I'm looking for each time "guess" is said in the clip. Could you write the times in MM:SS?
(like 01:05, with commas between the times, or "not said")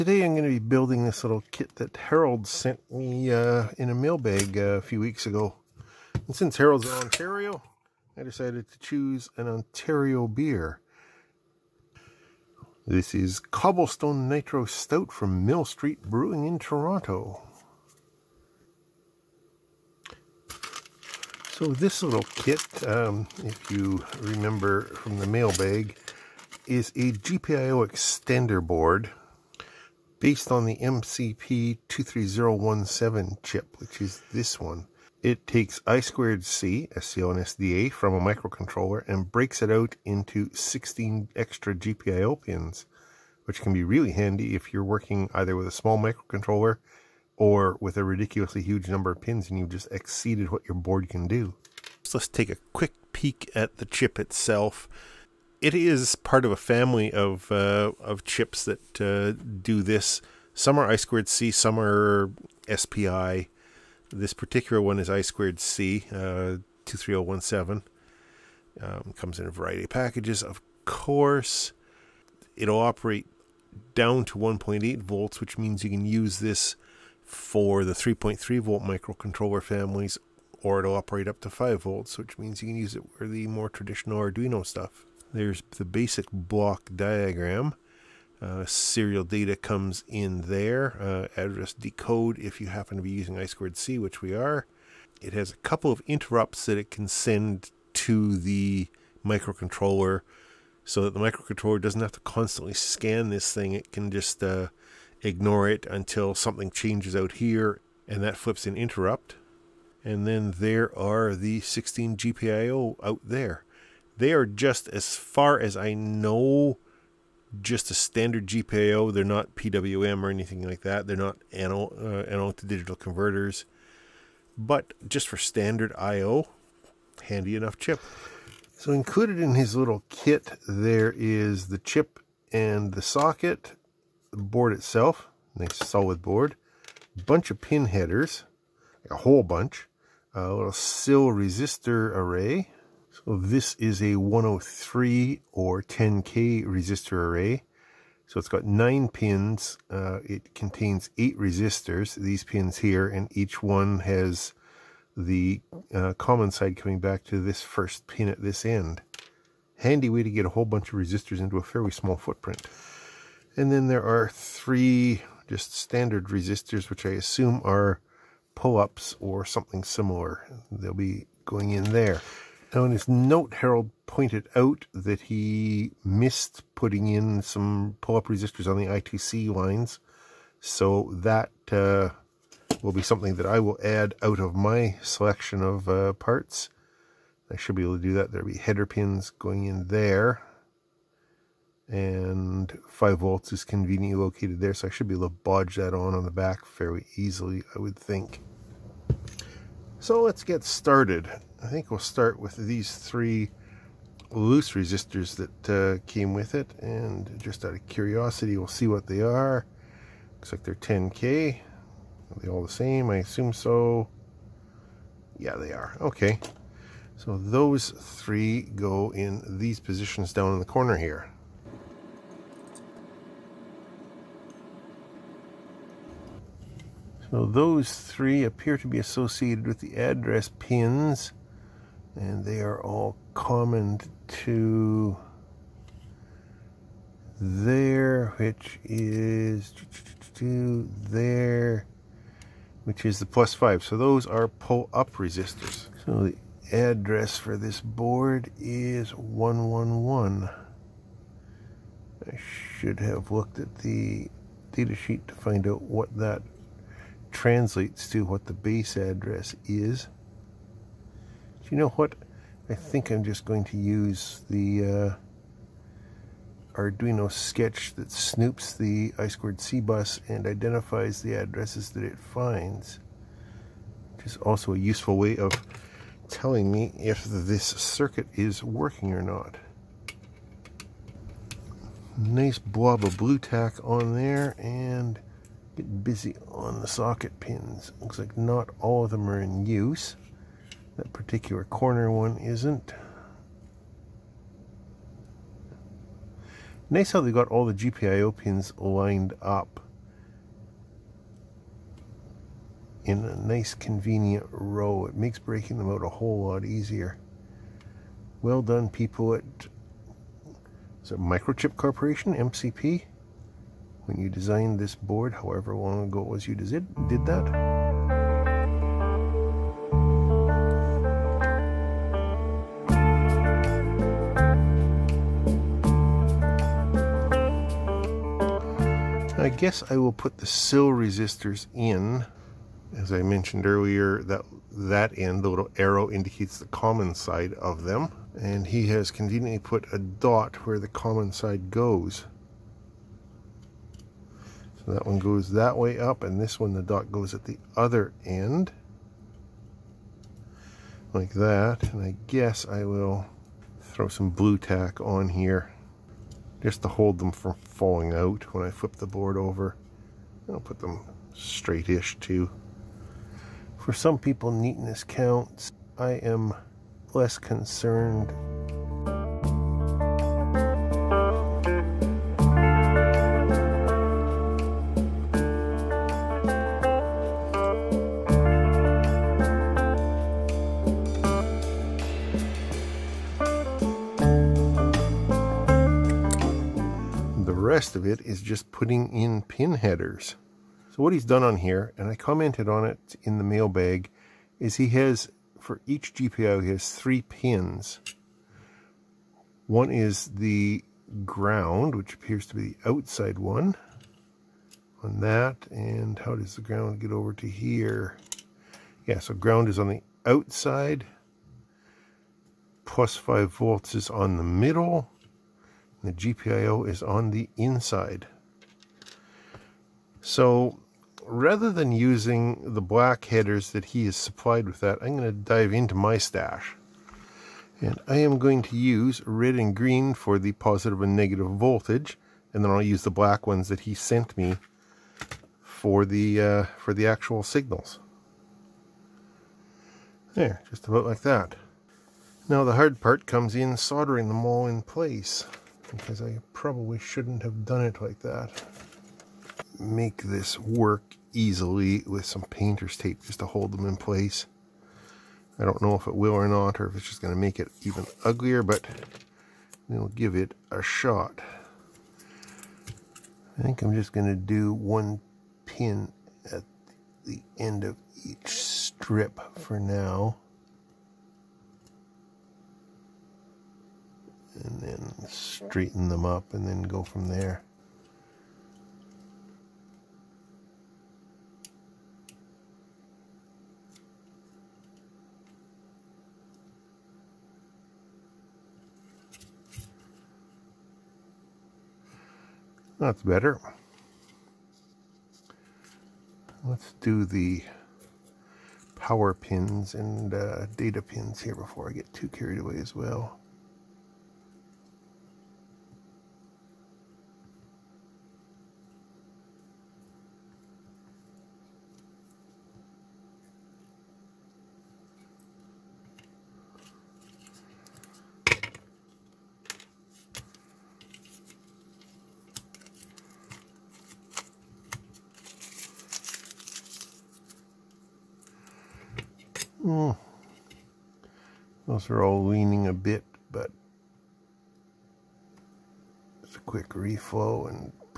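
05:29, 05:52.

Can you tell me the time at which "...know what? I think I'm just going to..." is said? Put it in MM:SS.
04:21.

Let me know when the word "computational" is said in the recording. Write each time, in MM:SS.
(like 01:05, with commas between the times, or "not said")
not said.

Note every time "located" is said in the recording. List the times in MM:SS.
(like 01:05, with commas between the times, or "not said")
03:14.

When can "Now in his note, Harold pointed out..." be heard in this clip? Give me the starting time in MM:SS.
02:52.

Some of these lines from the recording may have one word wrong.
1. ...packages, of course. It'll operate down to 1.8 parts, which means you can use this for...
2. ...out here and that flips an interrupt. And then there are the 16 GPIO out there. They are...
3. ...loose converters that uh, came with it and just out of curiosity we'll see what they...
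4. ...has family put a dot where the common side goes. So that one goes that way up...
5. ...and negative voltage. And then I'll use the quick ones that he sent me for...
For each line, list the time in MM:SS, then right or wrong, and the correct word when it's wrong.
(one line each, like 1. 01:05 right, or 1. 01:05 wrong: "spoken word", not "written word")
1. 01:09 wrong: "volts", not "parts"
2. 01:47 right
3. 03:24 wrong: "resistors", not "converters"
4. 05:38 wrong: "conveniently", not "family"
5. 07:11 wrong: "black", not "quick".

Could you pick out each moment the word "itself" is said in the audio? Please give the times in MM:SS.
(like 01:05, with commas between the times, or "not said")
00:54, 02:14.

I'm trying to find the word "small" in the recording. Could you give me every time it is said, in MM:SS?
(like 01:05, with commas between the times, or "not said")
00:45, 02:41.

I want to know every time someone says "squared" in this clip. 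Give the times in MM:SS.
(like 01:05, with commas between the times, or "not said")
00:35, 01:00, 01:05.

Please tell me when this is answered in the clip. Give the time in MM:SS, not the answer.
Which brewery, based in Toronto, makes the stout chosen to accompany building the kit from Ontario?
00:15.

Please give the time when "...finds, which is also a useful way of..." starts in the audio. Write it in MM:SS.
04:32.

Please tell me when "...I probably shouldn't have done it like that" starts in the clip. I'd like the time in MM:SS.
07:26.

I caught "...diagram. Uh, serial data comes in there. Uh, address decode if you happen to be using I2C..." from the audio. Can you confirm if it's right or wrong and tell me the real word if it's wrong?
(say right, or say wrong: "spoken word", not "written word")
right.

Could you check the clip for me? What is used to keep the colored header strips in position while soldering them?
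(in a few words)
painter's tape.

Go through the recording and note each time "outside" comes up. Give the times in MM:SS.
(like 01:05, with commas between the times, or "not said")
06:42, 06:50.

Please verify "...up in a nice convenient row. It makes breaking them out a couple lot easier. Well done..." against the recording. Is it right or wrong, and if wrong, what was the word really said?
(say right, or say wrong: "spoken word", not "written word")
wrong: "whole", not "couple".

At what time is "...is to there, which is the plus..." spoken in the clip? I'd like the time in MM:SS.
03:58.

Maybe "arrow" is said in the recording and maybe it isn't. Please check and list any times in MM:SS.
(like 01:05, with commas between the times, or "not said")
05:35.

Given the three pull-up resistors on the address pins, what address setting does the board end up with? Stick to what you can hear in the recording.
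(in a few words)
111.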